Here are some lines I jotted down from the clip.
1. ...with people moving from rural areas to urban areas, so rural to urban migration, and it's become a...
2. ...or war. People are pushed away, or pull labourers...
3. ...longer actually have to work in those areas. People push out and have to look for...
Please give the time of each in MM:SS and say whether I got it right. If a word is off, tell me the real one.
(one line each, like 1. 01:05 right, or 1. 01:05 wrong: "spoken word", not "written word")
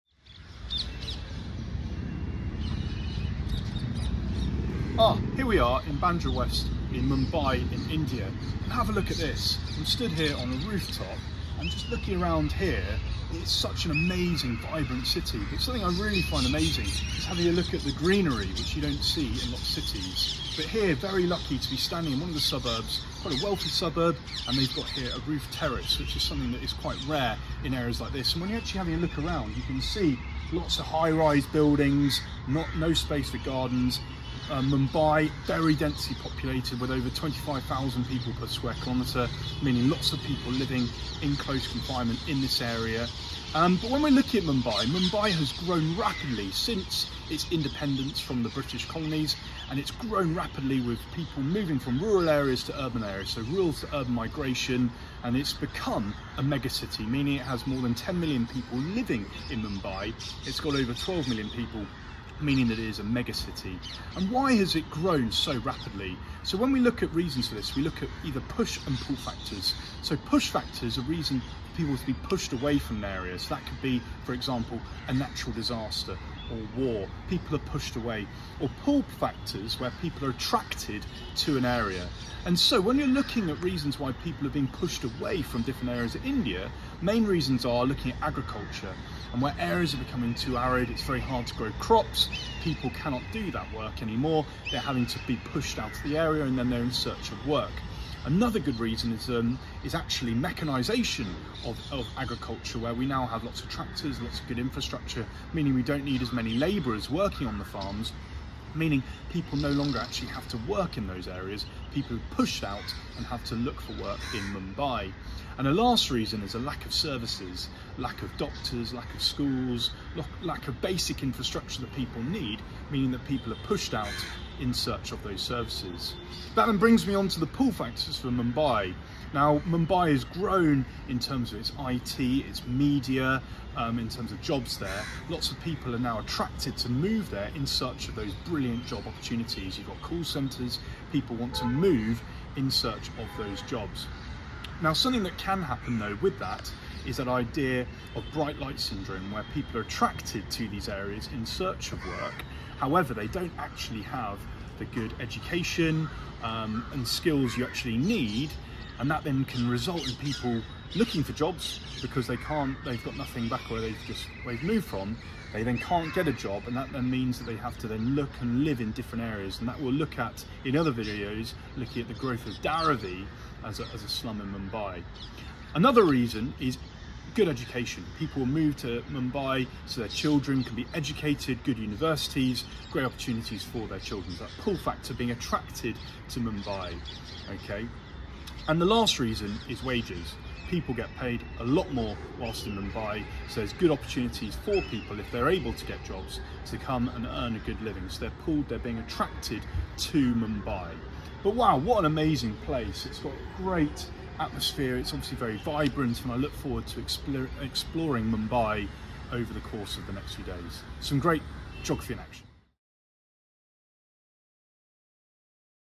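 1. 00:50 right
2. 01:16 wrong: "factors", not "labourers"
3. 01:49 right.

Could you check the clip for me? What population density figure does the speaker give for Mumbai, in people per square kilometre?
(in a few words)
25,000.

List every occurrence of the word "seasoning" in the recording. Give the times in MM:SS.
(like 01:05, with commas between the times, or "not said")
not said.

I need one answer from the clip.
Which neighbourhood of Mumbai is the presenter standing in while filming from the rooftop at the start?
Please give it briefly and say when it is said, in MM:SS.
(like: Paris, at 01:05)
Bandra West, at 00:05.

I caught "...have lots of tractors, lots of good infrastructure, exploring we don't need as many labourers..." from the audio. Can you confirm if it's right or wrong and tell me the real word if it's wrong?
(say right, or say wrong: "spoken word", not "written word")
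wrong: "meaning", not "exploring".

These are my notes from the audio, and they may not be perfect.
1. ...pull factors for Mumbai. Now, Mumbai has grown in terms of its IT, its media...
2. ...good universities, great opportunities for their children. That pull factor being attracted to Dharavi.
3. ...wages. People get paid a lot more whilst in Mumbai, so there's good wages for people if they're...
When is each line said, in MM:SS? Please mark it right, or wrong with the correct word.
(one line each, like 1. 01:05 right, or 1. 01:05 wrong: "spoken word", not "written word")
1. 02:07 right
2. 03:01 wrong: "Mumbai", not "Dharavi"
3. 03:09 wrong: "opportunities", not "wages".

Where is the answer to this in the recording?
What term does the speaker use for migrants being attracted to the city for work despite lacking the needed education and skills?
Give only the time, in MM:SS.
02:28.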